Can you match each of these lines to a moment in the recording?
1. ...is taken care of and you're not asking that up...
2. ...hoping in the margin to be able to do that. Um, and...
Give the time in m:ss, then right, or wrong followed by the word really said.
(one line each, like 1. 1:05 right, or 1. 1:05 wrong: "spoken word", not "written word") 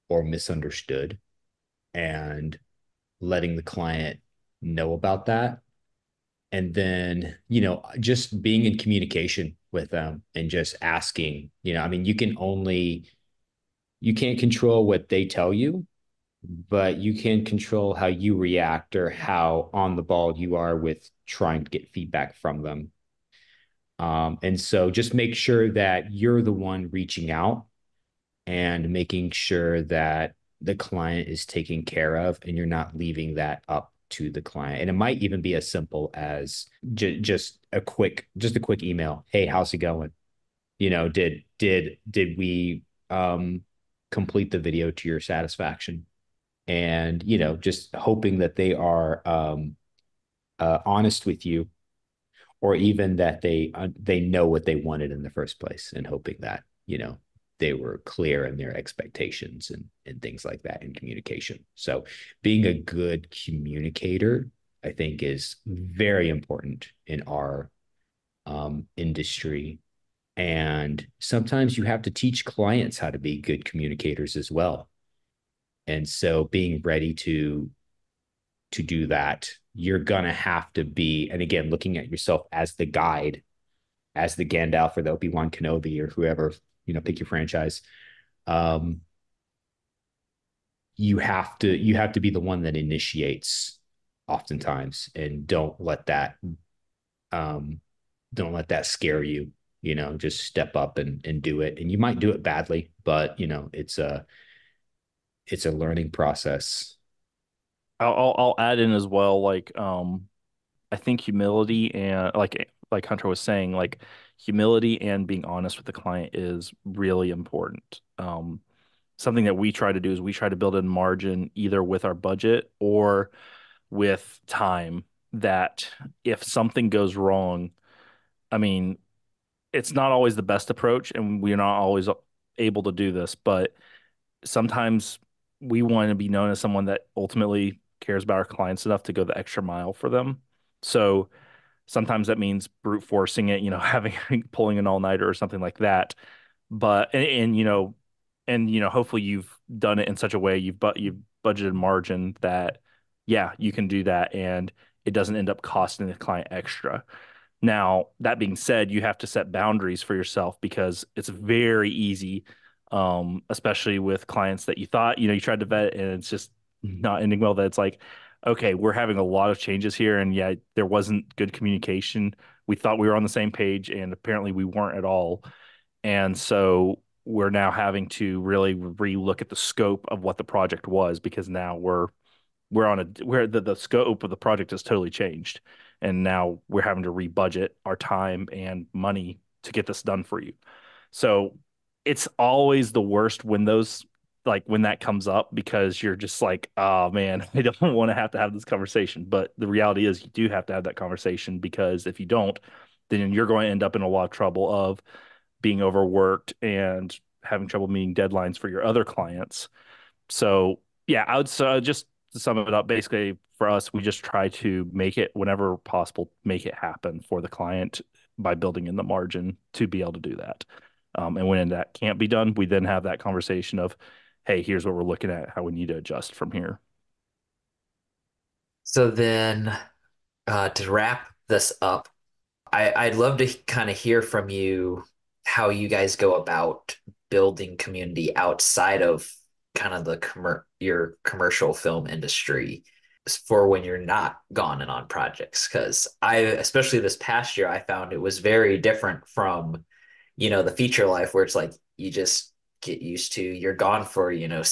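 1. 0:31 wrong: "leaving", not "asking"
2. 3:38 wrong: "building", not "hoping".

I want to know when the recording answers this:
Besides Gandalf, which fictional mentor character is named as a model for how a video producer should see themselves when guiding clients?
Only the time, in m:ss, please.
1:25.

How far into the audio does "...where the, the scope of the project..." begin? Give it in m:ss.
3:03.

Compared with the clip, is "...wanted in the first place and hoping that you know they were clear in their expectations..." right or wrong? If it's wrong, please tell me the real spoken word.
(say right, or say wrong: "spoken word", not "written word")
right.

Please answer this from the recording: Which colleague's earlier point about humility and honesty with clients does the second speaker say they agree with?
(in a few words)
Hunter.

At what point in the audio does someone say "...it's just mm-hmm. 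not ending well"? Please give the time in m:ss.
2:46.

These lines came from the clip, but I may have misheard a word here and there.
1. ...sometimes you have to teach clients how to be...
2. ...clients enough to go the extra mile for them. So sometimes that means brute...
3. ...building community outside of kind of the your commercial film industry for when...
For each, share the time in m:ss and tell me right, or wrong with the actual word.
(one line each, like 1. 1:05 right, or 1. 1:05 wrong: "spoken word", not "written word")
1. 1:11 right
2. 2:18 right
3. 3:57 right.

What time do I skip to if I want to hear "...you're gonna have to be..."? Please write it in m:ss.
1:19.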